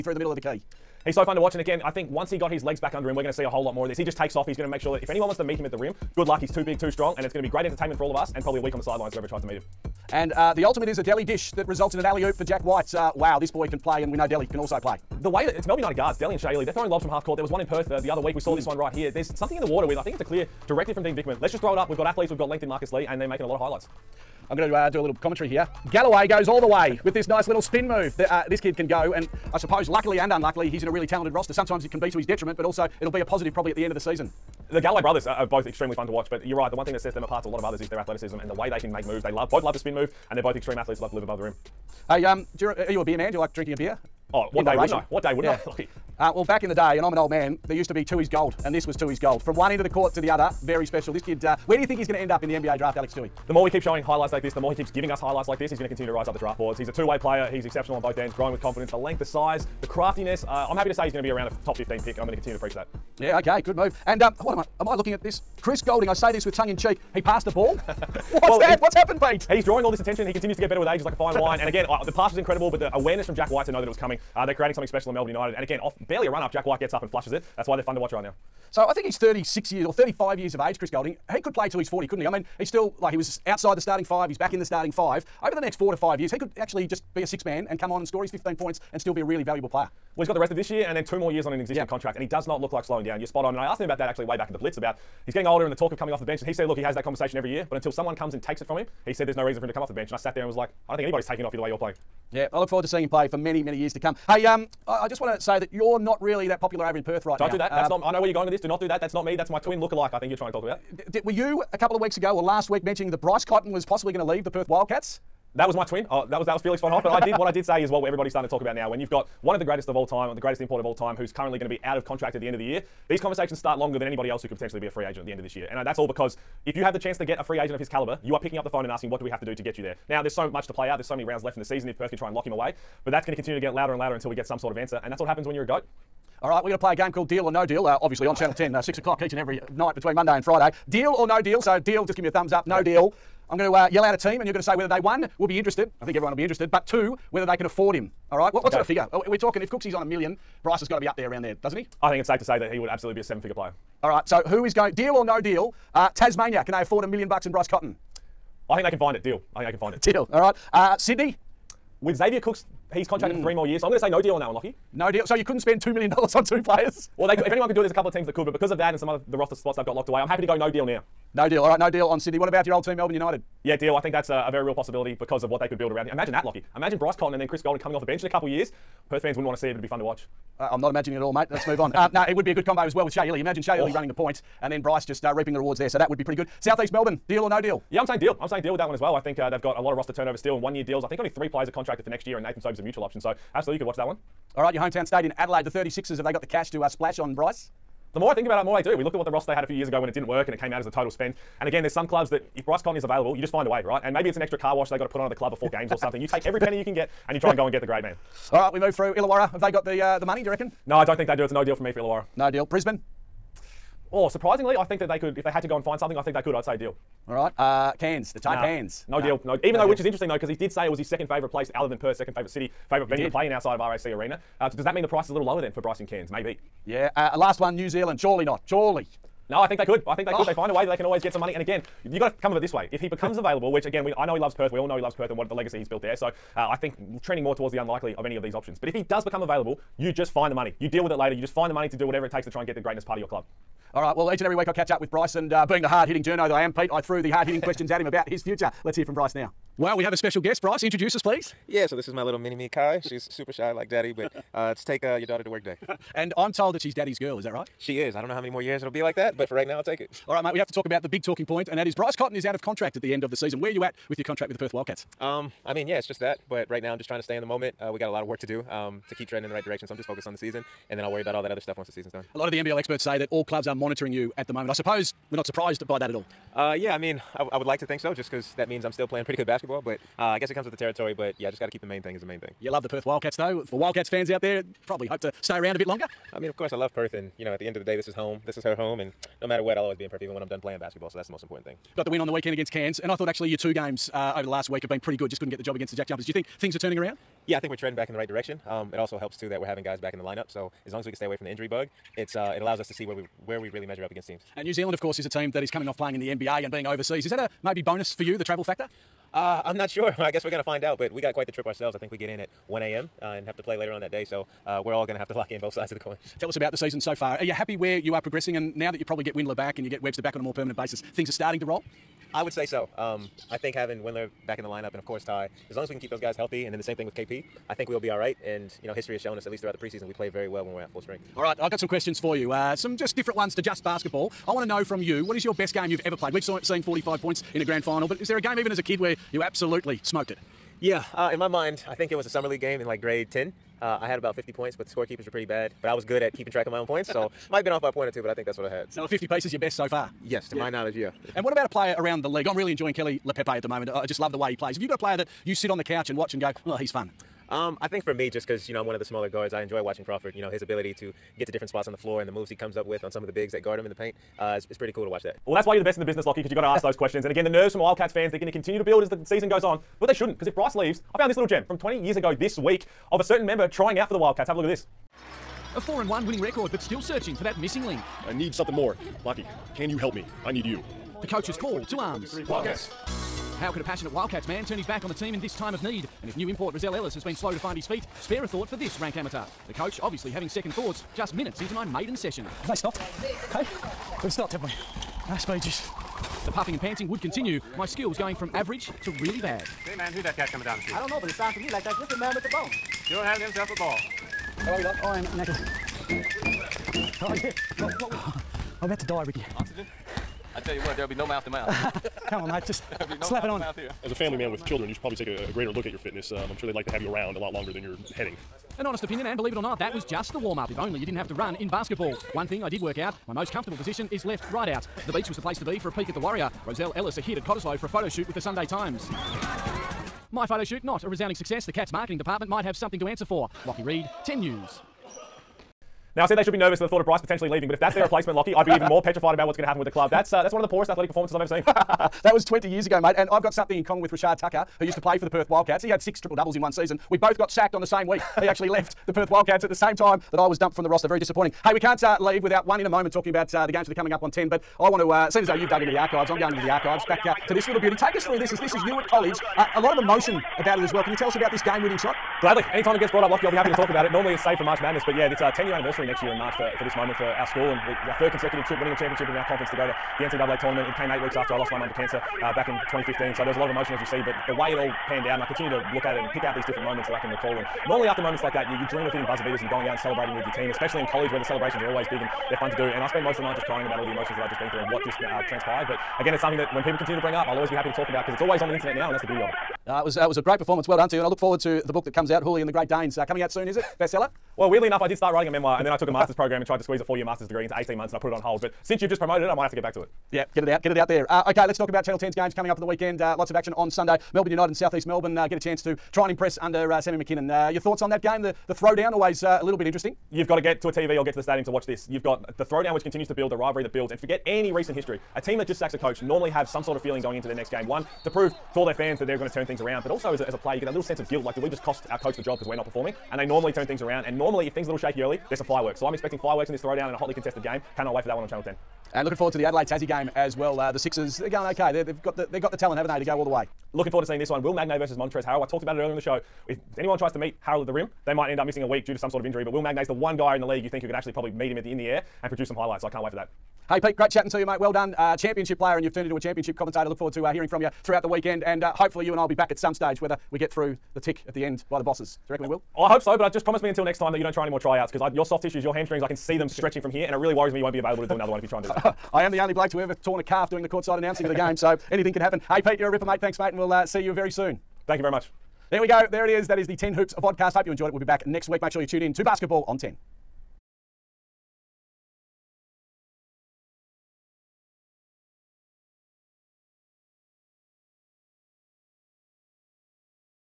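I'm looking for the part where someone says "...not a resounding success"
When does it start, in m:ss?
7:10.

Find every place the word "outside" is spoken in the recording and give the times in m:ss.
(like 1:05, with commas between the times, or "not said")
1:23, 3:43.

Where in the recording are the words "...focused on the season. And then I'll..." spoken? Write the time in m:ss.
4:30.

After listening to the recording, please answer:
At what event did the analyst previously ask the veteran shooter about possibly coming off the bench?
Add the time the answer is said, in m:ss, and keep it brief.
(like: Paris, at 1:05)
The Blitz, at 1:34.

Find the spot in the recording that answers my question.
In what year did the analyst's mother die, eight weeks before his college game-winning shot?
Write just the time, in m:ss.
7:52.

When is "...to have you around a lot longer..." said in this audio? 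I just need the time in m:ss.
6:56.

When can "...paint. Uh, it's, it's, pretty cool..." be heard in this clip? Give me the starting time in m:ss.
6:03.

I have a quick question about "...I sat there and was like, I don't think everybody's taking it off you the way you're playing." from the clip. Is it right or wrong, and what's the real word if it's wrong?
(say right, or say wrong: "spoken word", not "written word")
wrong: "anybody", not "everybody".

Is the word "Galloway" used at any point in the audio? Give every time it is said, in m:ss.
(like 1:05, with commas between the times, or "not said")
0:25, 0:34.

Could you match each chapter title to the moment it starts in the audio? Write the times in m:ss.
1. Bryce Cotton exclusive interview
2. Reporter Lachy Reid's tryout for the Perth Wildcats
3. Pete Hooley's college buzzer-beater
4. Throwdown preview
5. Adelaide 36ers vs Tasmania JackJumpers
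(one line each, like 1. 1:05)
1. 4:03
2. 6:05
3. 7:31
4. 8:19
5. 8:48.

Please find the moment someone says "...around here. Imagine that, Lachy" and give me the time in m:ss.
2:55.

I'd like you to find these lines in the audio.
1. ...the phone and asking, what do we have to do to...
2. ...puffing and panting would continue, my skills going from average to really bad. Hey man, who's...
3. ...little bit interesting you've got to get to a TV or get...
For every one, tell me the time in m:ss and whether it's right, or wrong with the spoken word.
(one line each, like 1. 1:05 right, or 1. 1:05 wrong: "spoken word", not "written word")
1. 2:08 right
2. 6:36 right
3. 8:29 right.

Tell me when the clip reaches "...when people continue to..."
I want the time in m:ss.
8:06.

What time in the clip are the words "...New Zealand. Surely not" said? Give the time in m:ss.
3:47.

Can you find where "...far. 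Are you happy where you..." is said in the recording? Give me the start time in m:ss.
5:17.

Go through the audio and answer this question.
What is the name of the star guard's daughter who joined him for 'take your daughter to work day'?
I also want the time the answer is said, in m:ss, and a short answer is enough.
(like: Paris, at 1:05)
Kai, at 4:12.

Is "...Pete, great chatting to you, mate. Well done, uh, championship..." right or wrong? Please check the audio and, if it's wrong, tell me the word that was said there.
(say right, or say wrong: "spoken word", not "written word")
right.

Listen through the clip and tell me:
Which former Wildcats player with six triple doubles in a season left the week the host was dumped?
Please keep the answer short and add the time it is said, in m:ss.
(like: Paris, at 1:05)
Rashad Tucker, at 7:24.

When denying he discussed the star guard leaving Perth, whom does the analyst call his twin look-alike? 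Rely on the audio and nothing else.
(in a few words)
Felix von Hoff.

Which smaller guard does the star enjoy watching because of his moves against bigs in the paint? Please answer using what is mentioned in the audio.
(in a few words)
Crawford.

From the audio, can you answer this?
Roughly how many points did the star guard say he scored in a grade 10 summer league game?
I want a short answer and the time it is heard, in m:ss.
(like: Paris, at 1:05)
50, at 5:44.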